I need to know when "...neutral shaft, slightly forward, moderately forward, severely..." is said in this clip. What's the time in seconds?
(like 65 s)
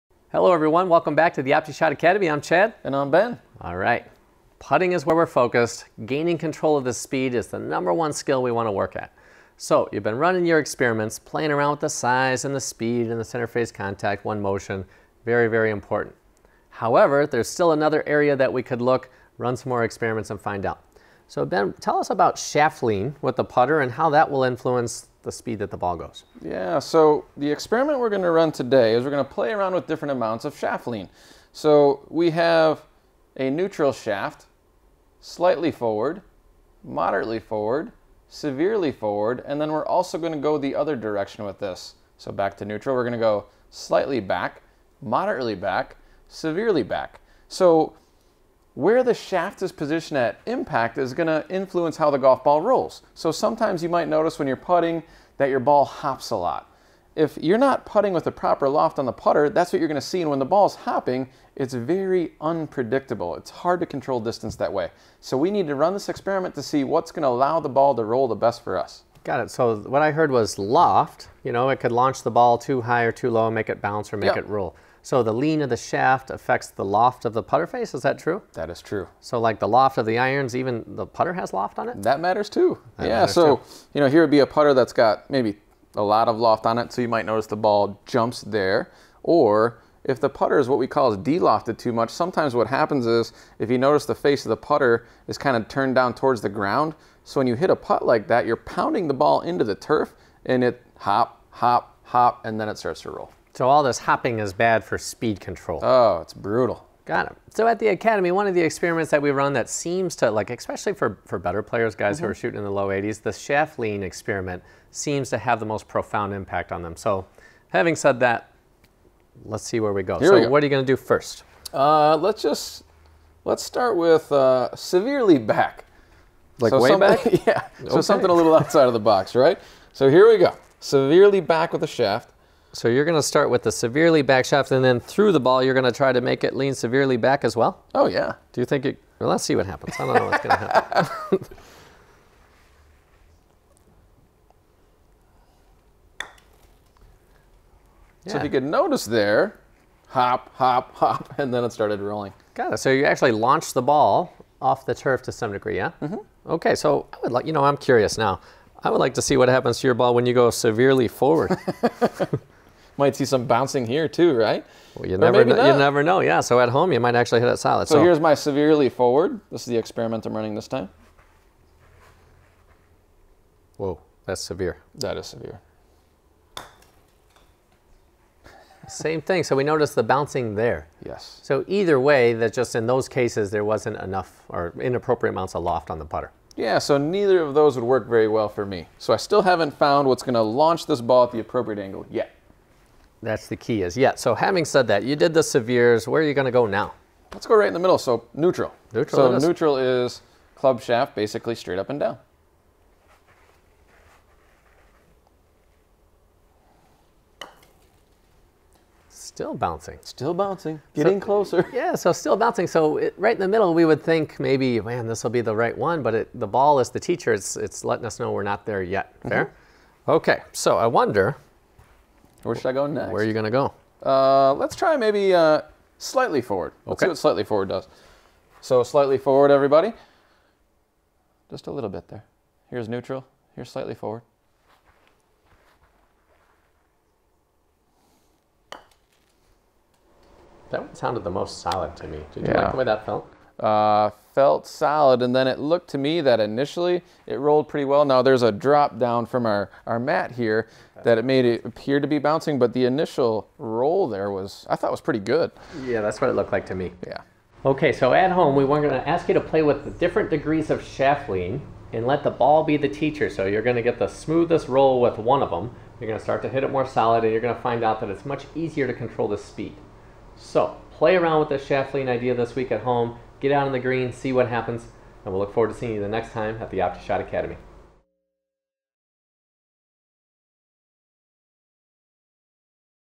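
33 s.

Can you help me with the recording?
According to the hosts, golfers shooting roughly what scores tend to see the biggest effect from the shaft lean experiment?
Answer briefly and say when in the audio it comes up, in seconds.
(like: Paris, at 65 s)
low 80s, at 112 s.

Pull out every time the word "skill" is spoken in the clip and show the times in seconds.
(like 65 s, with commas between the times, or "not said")
8 s.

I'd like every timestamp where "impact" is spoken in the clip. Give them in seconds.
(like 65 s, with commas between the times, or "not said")
50 s, 116 s.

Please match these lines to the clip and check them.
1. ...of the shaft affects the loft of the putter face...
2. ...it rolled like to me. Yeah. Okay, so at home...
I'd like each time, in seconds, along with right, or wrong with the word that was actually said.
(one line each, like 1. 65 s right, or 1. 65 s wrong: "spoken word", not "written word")
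1. 75 s right
2. 256 s wrong: "looked", not "rolled".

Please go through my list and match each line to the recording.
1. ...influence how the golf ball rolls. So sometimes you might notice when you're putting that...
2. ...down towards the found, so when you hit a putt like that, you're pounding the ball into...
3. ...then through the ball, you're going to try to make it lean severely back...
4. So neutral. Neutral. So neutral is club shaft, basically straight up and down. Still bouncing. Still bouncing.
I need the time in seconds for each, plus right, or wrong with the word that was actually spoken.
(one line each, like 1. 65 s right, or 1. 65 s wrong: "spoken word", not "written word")
1. 51 s right
2. 95 s wrong: "ground", not "found"
3. 134 s right
4. 197 s right.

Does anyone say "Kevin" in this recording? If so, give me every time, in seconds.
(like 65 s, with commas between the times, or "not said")
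not said.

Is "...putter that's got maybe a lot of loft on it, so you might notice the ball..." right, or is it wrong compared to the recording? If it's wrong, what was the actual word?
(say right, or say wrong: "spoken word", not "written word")
right.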